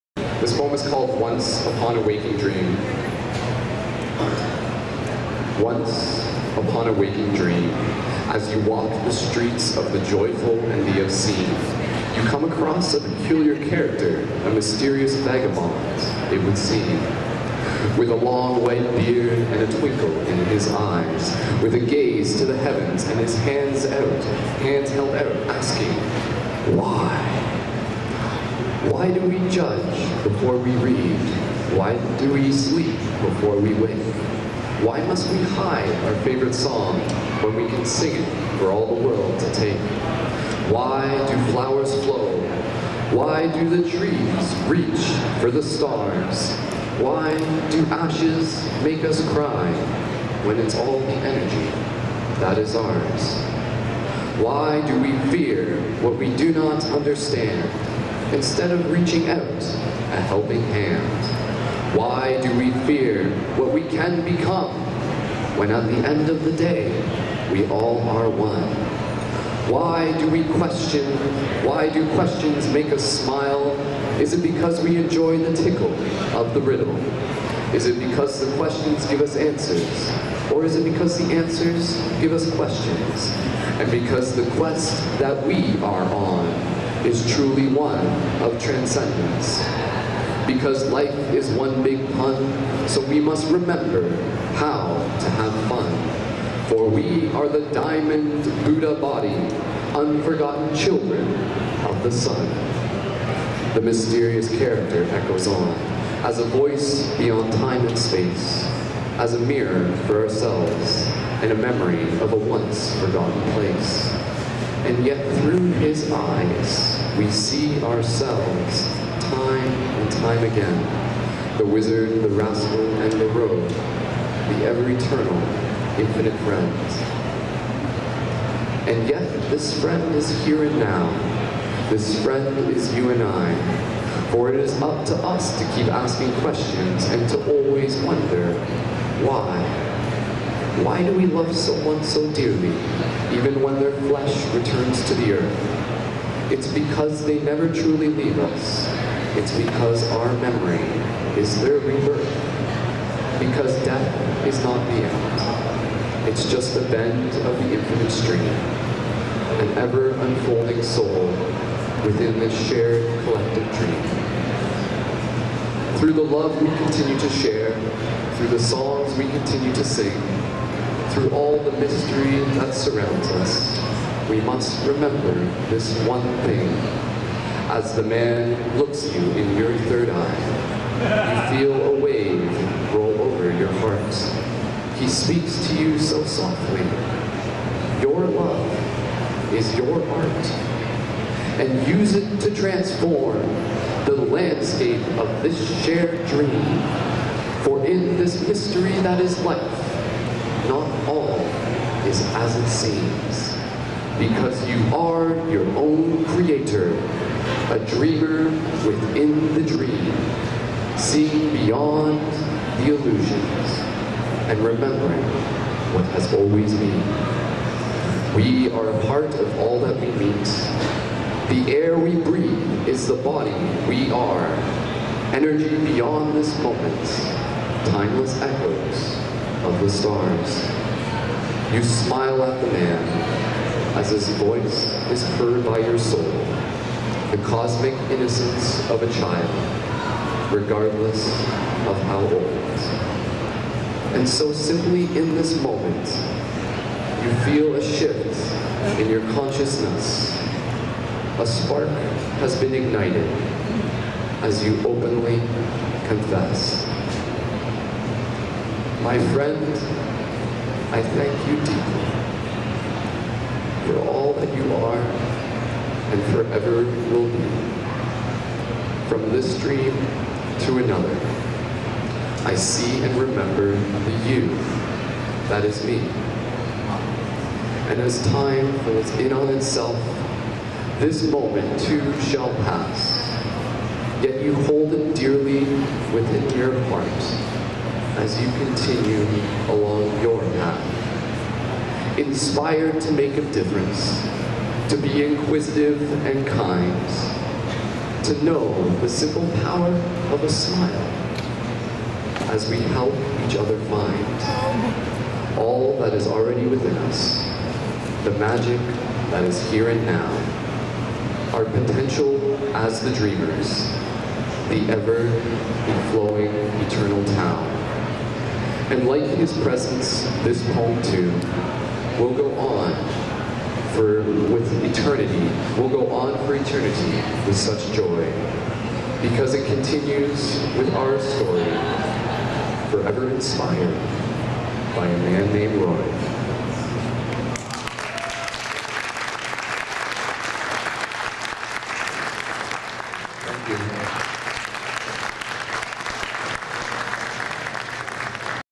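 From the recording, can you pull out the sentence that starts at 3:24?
Because you are your own creator, a dreamer within the dream, seeing beyond the illusions and remembering what has always been.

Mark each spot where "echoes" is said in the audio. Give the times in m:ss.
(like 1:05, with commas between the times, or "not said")
1:45, 3:48.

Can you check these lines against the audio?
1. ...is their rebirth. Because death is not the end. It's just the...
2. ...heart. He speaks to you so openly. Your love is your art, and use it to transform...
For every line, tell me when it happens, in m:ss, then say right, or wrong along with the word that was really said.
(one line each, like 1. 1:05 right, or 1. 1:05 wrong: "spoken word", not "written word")
1. 2:31 right
2. 3:03 wrong: "softly", not "openly".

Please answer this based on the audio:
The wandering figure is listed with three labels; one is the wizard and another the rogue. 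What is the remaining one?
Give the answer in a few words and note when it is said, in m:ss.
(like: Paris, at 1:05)
the rascal, at 2:02.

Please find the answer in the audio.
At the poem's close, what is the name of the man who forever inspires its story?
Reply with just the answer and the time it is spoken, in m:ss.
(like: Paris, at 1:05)
Roy, at 5:35.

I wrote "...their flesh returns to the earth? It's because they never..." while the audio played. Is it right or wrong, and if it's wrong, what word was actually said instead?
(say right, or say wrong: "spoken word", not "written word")
right.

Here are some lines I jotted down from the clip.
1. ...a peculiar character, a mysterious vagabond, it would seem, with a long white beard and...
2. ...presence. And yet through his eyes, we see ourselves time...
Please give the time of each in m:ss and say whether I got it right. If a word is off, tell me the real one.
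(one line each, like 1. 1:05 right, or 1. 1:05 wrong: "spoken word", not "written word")
1. 0:12 right
2. 1:53 wrong: "place", not "presence".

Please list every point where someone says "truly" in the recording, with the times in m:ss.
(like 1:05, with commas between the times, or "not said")
1:27, 2:27.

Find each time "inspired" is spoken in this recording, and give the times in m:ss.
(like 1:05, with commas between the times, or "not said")
4:52, 5:33.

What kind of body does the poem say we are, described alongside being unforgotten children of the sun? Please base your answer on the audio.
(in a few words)
diamond Buddha body.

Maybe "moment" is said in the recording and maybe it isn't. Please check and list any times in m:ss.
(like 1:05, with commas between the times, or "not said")
3:46, 4:05, 4:41.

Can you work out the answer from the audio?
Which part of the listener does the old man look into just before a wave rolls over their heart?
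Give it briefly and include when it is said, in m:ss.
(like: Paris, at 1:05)
third eye, at 2:59.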